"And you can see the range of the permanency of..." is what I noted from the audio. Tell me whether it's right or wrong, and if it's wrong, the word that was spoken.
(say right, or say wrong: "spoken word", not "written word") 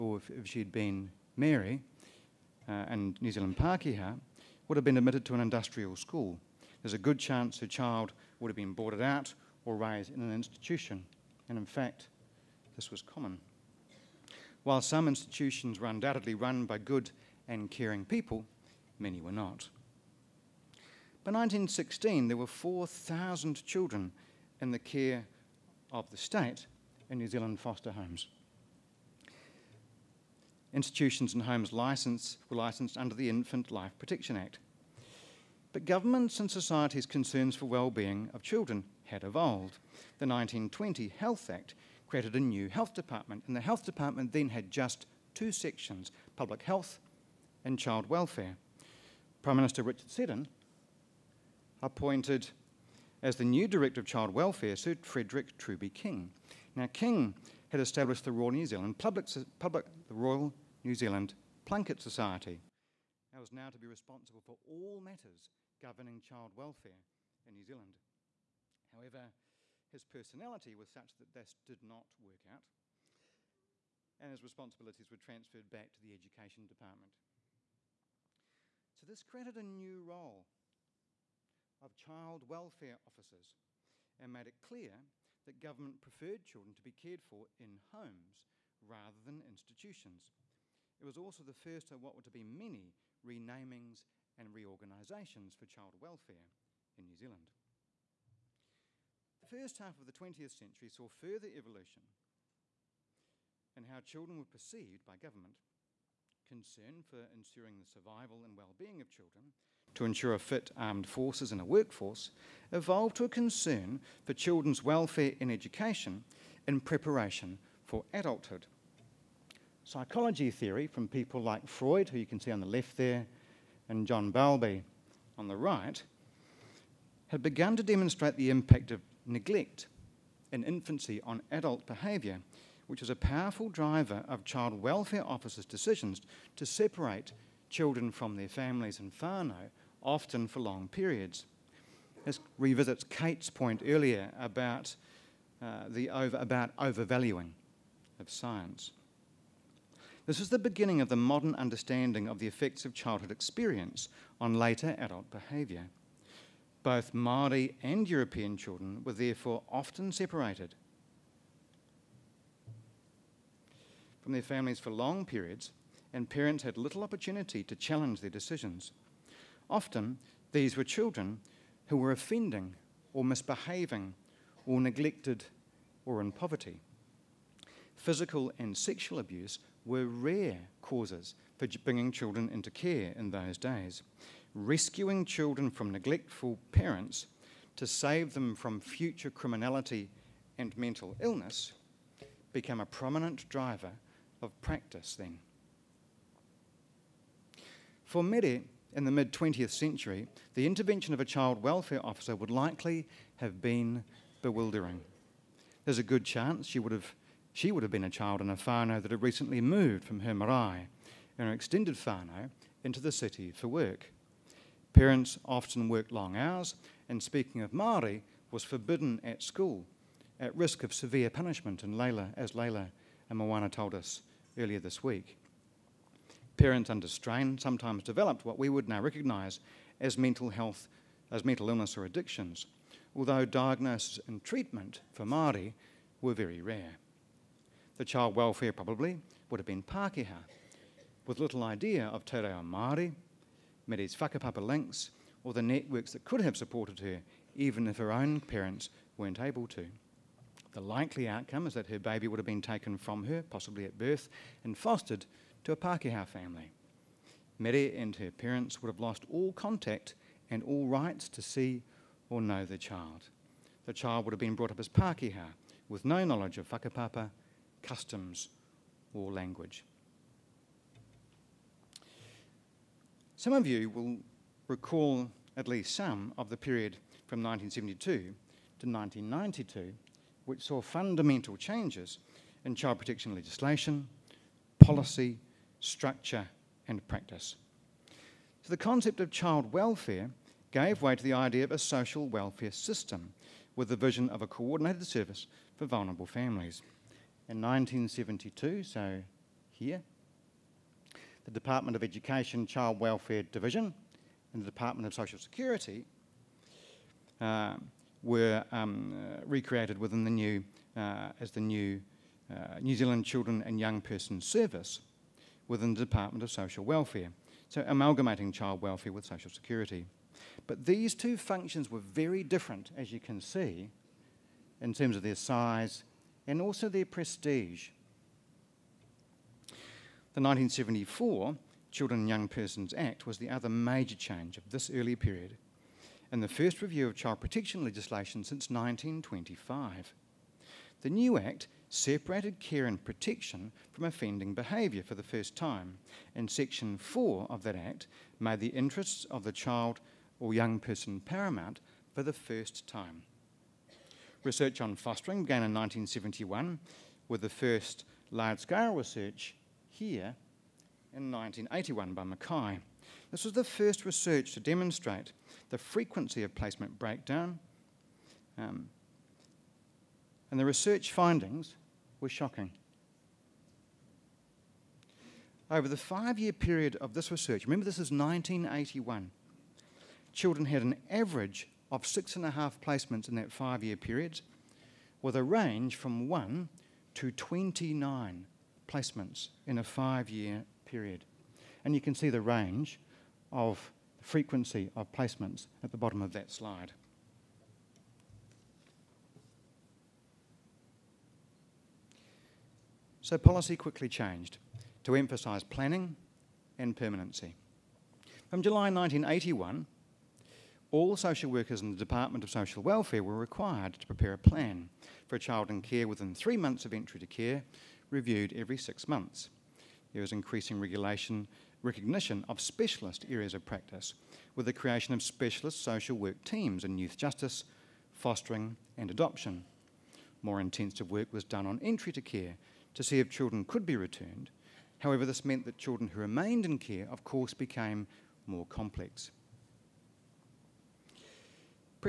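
wrong: "frequency", not "permanency".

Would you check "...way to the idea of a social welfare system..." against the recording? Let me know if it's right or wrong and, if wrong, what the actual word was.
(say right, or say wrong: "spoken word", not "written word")
right.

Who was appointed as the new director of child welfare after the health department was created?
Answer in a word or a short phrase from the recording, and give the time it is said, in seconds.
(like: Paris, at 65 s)
Sir Frederick Truby King, at 54 s.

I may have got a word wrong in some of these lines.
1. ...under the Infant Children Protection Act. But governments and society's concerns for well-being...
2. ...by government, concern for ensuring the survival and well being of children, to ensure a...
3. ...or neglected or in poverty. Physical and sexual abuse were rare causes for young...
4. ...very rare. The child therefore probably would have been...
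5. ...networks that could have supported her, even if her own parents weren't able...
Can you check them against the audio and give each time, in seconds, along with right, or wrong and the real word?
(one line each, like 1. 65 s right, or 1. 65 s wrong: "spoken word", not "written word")
1. 32 s wrong: "Life", not "Children"
2. 105 s right
3. 174 s wrong: "bringing", not "young"
4. 236 s wrong: "welfare", not "therefore"
5. 245 s right.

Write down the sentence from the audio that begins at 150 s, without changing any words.
This is the beginning of the modern understanding of the effects of childhood experience on later adult behaviour.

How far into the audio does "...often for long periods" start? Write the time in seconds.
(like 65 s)
140 s.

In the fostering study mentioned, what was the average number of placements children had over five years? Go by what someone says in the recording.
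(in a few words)
6.5.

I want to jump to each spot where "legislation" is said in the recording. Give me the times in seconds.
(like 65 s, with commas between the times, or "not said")
283 s, 337 s.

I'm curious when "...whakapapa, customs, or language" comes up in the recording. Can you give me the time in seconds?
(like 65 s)
266 s.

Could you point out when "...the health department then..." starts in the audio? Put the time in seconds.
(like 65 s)
43 s.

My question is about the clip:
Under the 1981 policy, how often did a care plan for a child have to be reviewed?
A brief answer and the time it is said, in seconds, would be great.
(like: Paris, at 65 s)
every 6 months, at 418 s.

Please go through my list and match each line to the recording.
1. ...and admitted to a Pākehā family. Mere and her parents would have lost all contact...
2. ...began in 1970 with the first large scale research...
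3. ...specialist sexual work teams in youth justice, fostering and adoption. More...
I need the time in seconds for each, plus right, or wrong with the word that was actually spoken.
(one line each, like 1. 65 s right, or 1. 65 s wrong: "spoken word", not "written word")
1. 254 s wrong: "fostered", not "admitted"
2. 355 s wrong: "1971", not "1970"
3. 425 s wrong: "social", not "sexual".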